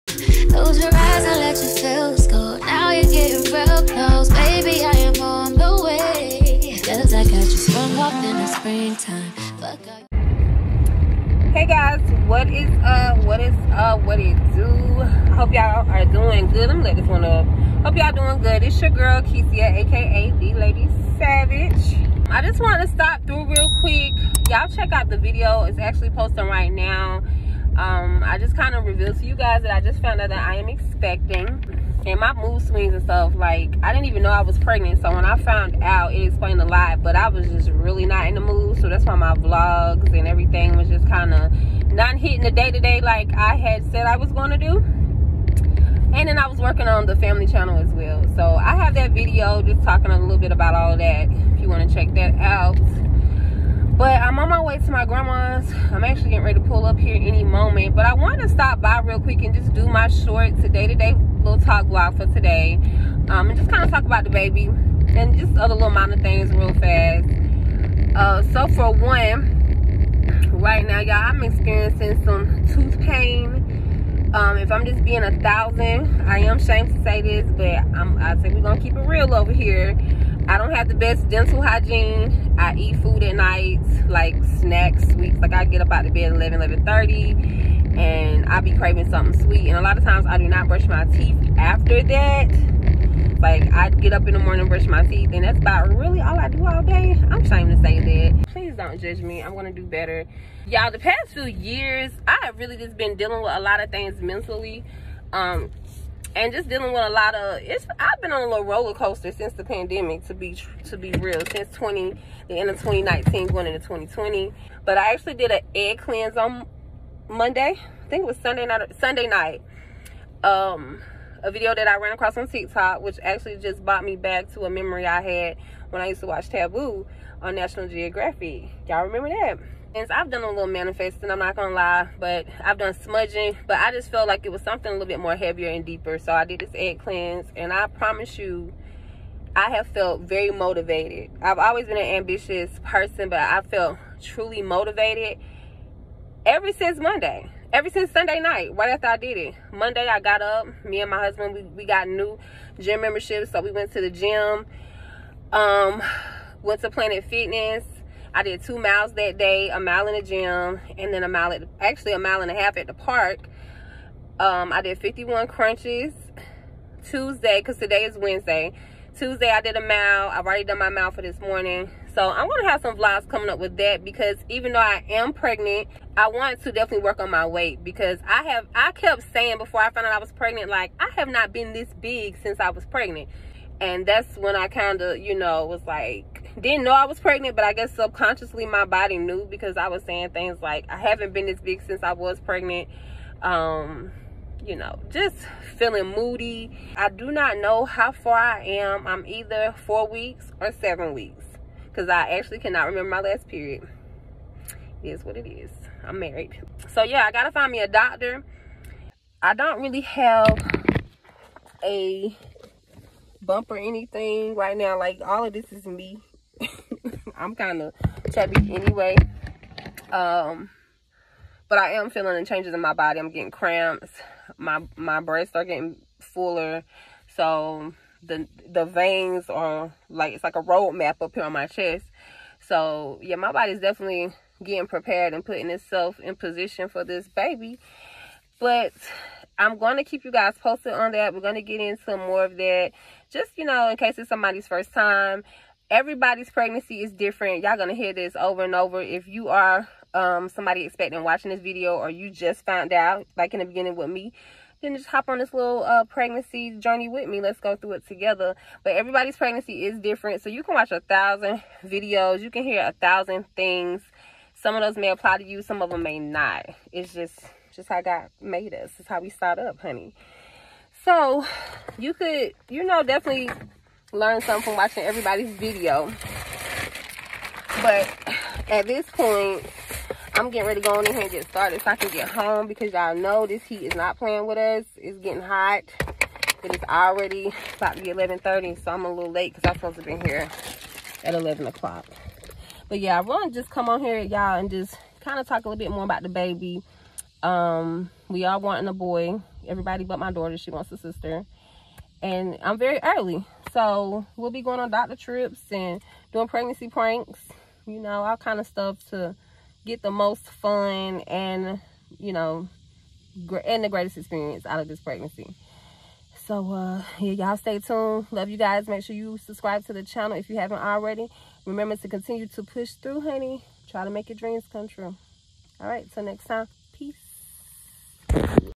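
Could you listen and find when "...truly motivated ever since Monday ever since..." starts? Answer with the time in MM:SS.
02:24.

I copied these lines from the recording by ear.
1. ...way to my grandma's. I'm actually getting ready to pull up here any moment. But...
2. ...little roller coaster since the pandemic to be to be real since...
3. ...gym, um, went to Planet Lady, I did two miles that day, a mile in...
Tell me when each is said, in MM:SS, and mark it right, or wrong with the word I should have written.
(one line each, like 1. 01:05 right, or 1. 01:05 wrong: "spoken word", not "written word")
1. 00:54 right
2. 01:48 right
3. 02:34 wrong: "Fitness", not "Lady".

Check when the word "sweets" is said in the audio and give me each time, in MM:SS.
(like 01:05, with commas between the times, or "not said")
01:25, 01:29.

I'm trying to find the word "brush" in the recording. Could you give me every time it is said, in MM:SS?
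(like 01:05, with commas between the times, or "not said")
01:30, 01:34.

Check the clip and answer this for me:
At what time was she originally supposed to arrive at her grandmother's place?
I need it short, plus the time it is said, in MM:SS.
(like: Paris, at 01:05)
11 o'clock, at 04:51.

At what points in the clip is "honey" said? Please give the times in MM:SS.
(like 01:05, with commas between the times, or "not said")
04:29, 05:23.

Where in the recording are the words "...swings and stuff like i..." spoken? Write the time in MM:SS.
00:32.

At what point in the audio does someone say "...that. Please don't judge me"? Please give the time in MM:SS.
01:38.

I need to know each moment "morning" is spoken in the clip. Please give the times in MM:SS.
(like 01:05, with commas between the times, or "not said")
01:34, 02:51.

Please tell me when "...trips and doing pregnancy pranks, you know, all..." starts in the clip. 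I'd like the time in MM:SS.
05:05.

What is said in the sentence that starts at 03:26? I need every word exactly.
So yeah, I got to find me a doctor.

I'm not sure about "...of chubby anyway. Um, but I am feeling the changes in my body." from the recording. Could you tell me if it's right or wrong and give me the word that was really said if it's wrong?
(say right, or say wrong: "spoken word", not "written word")
right.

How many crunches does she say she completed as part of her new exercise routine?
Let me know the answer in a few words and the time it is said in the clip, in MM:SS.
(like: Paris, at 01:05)
51, at 02:44.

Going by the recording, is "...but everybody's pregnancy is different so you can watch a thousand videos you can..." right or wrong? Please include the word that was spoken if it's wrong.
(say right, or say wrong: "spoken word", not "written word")
right.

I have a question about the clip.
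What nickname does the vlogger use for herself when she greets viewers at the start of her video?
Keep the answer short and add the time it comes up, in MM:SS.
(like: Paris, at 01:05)
the Lady Savage, at 00:20.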